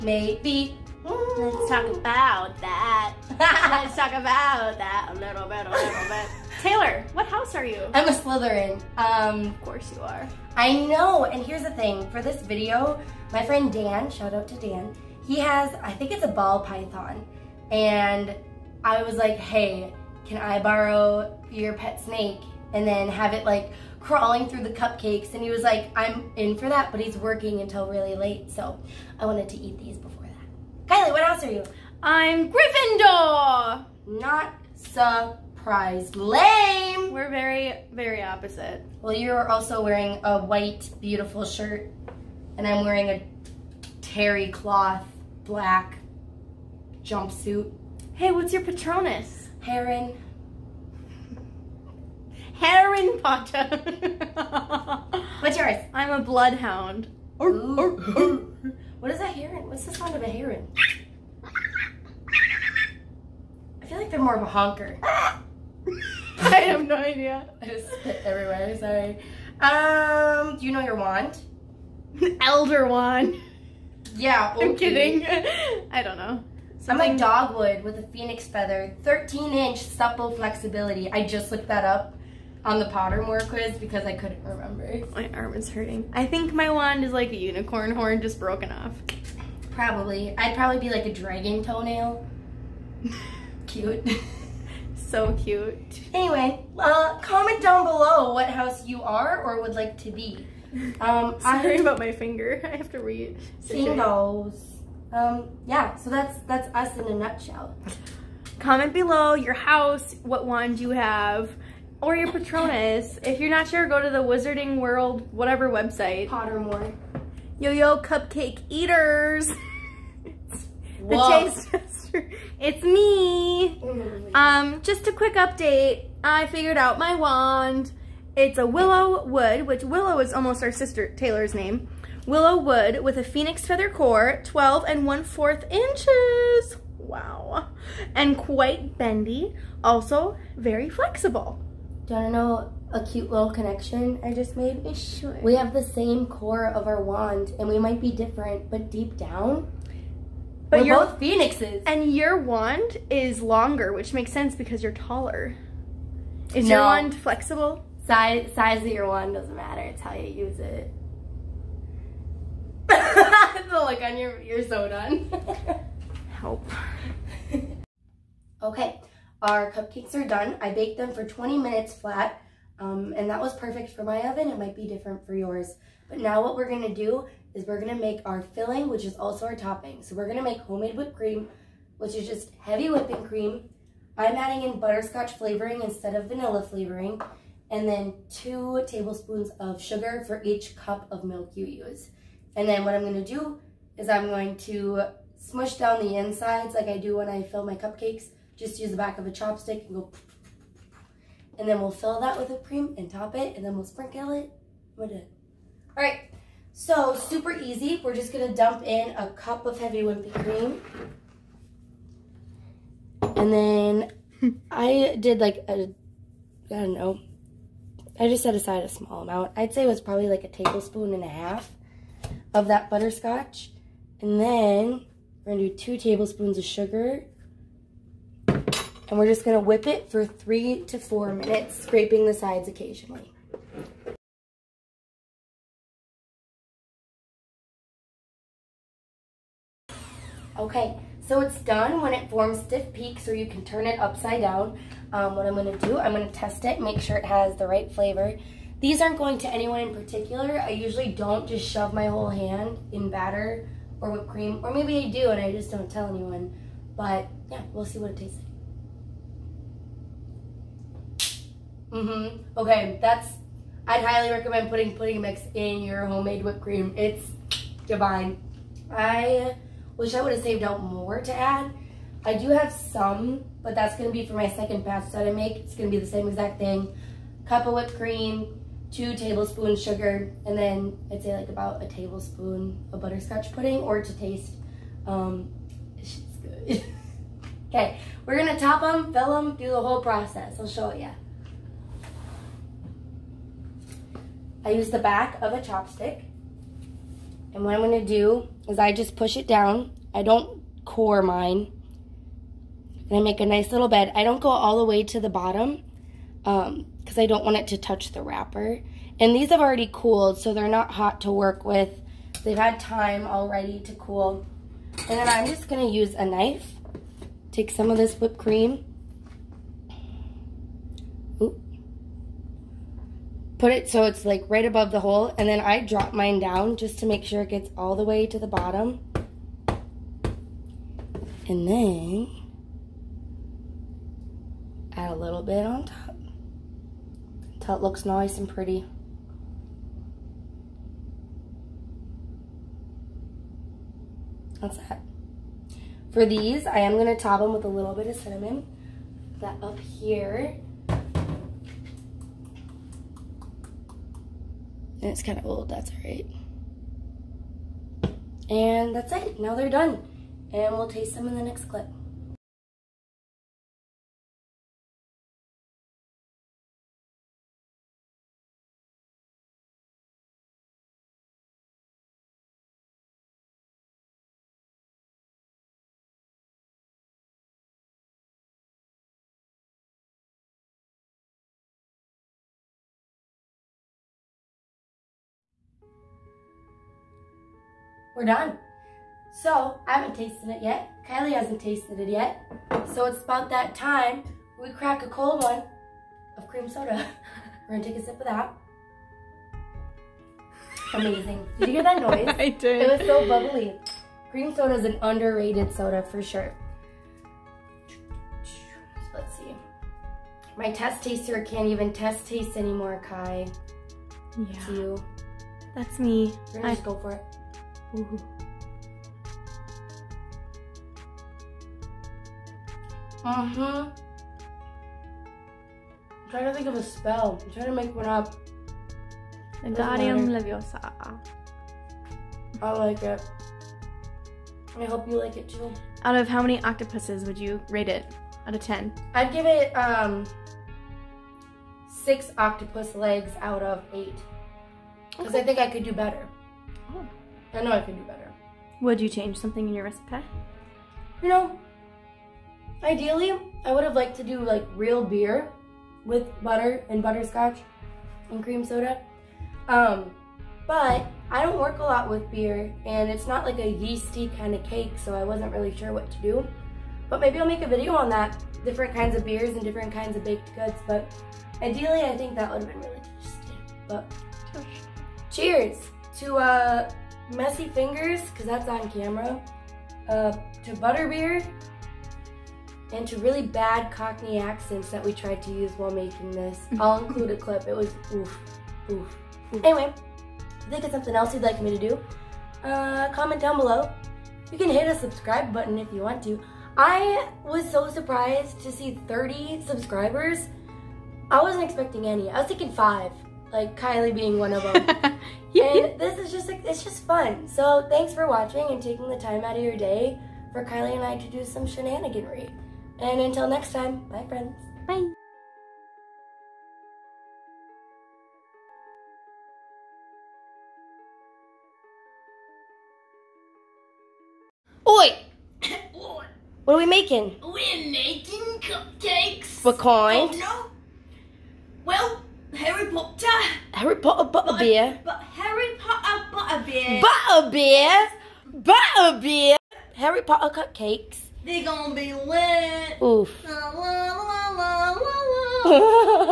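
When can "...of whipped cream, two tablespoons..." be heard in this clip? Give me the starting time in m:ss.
4:37.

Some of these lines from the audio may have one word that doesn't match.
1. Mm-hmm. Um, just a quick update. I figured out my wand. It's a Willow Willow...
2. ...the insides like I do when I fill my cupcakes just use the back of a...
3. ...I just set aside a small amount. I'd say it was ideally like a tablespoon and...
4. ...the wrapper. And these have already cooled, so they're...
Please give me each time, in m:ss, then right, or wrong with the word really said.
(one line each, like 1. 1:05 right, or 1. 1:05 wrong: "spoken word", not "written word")
1. 2:03 wrong: "Wood", not "Willow"
2. 3:16 right
3. 3:38 wrong: "probably", not "ideally"
4. 5:08 right.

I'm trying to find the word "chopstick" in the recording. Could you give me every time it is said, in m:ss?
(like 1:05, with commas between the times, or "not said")
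3:19, 4:55.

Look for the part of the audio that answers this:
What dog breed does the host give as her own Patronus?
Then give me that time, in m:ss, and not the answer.
0:56.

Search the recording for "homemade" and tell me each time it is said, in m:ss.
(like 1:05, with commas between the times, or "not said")
3:00, 4:26.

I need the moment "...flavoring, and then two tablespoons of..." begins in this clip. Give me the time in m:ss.
3:06.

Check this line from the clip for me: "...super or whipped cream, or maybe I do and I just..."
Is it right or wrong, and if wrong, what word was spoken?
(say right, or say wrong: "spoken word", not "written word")
wrong: "batter", not "super".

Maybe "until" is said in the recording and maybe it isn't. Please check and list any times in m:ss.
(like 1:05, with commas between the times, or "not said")
0:27, 5:37, 8:33.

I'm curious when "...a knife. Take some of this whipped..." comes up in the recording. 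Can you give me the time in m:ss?
5:16.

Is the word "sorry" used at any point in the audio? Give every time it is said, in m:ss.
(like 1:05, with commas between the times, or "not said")
1:08, 1:41.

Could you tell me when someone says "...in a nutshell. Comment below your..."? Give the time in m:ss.
1:46.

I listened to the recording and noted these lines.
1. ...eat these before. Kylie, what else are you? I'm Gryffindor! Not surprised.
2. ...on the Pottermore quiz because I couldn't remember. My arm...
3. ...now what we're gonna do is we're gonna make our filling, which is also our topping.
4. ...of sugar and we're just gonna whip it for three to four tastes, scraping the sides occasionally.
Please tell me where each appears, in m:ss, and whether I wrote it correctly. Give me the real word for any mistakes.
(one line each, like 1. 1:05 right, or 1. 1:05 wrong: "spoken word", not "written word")
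1. 0:29 right
2. 1:22 right
3. 2:56 right
4. 3:46 wrong: "minutes", not "tastes".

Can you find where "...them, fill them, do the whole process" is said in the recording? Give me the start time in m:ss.
4:48.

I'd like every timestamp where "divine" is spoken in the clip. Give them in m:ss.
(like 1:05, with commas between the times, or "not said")
4:27.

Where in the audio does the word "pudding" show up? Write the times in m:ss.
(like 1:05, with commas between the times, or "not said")
4:24, 4:43.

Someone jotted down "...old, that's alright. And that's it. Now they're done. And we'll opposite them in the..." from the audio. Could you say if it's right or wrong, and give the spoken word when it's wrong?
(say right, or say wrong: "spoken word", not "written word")
wrong: "taste", not "opposite".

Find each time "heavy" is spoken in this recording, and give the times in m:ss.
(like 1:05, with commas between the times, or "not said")
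3:02, 3:29.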